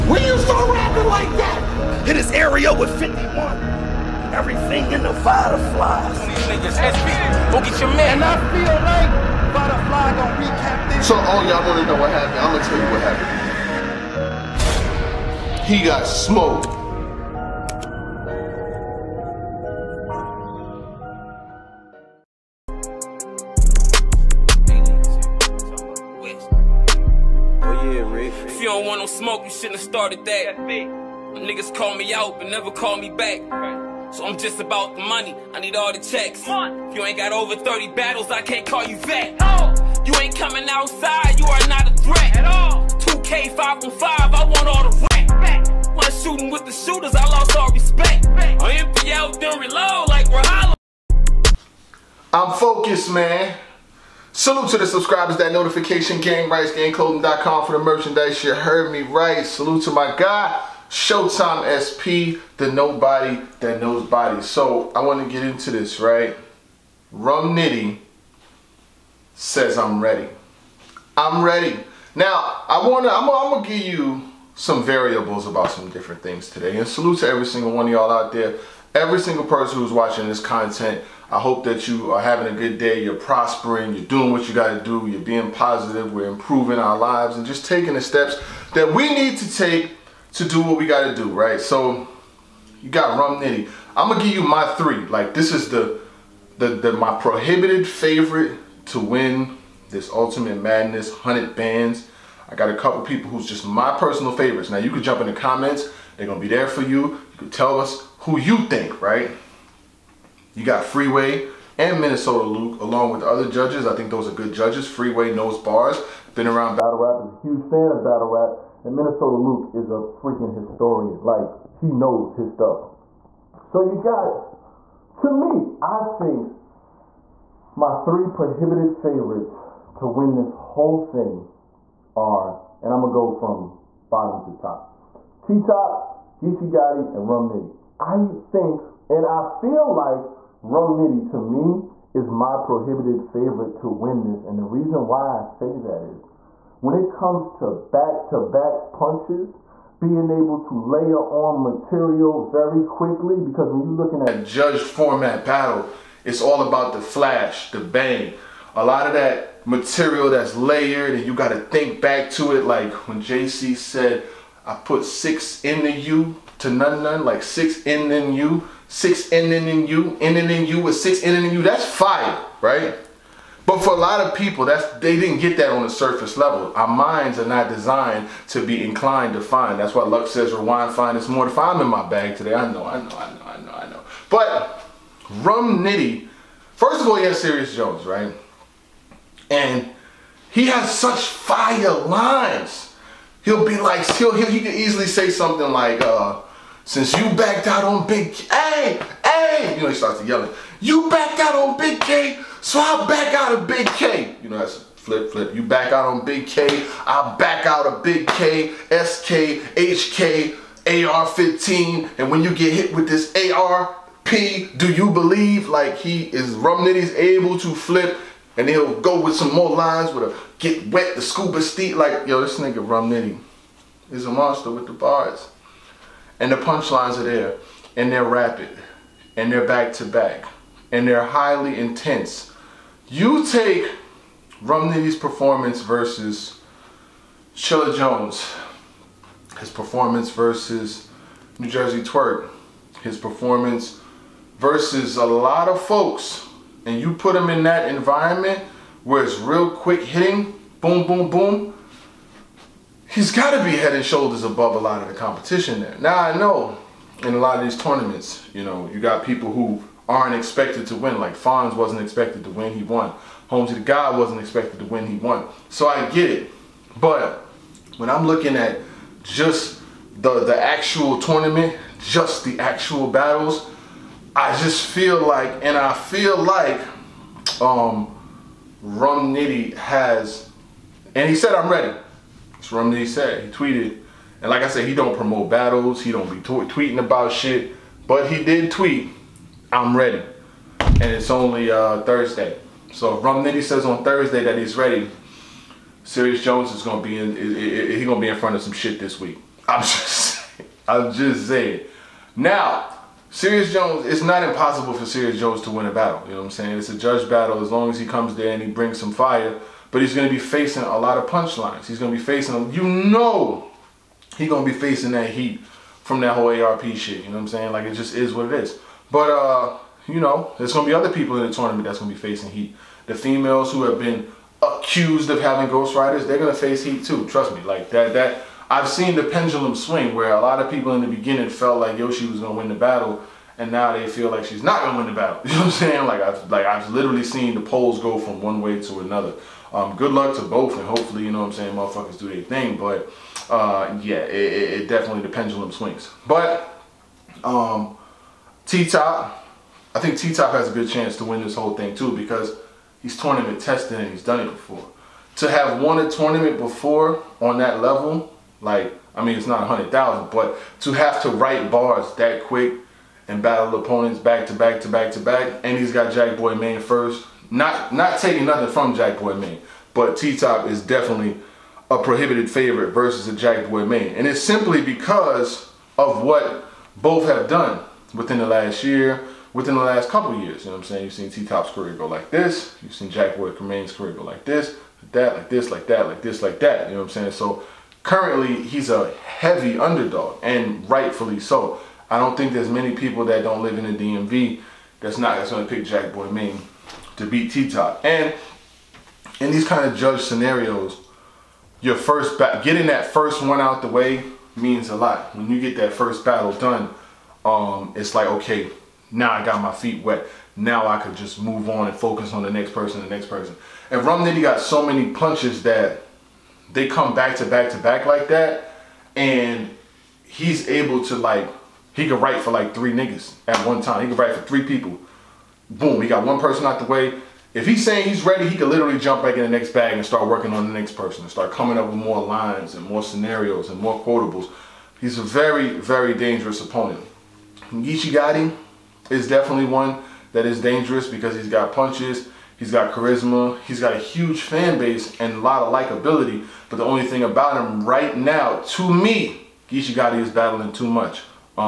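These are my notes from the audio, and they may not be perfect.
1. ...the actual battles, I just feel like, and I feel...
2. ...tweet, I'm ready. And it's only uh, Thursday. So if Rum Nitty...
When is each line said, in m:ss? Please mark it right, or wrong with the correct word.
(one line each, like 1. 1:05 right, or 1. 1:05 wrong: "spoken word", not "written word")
1. 4:32 right
2. 4:48 right.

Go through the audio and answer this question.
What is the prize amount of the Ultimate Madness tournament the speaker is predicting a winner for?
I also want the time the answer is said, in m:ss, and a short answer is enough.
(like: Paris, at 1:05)
100 bands, at 1:41.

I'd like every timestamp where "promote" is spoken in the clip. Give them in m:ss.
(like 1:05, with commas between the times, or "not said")
4:45.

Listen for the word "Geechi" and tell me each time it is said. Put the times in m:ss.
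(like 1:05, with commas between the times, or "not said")
2:16, 7:29.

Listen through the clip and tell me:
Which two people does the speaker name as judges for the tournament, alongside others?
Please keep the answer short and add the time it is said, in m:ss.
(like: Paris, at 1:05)
Freeway and Minnesota Luke, at 1:50.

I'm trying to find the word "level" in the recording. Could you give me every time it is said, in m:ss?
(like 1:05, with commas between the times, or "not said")
2:56, 5:57.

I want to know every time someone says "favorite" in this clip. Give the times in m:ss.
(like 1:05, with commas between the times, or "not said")
1:37, 1:44, 2:08, 2:23, 6:12.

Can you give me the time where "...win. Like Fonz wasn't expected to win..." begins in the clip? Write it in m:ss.
4:20.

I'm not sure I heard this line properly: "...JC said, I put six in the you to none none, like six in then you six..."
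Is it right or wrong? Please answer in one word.
right.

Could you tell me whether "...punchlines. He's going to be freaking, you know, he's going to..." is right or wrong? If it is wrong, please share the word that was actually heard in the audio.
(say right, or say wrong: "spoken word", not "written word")
wrong: "facing", not "freaking".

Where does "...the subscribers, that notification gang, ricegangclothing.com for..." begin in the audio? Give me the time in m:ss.
0:54.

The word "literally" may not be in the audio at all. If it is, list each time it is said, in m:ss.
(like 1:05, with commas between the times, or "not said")
5:36, 7:08.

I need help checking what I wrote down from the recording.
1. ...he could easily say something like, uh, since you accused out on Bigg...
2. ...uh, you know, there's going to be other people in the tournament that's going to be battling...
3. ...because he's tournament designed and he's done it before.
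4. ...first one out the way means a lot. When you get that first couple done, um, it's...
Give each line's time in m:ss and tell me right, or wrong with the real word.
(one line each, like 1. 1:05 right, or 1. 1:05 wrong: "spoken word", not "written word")
1. 3:14 wrong: "backed", not "accused"
2. 5:19 wrong: "facing", not "battling"
3. 5:52 wrong: "tested", not "designed"
4. 6:43 wrong: "battle", not "couple".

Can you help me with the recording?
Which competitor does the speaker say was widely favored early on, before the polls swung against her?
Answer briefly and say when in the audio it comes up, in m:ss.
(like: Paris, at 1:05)
Yoshi, at 5:31.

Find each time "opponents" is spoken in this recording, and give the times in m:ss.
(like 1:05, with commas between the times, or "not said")
6:03, 7:16.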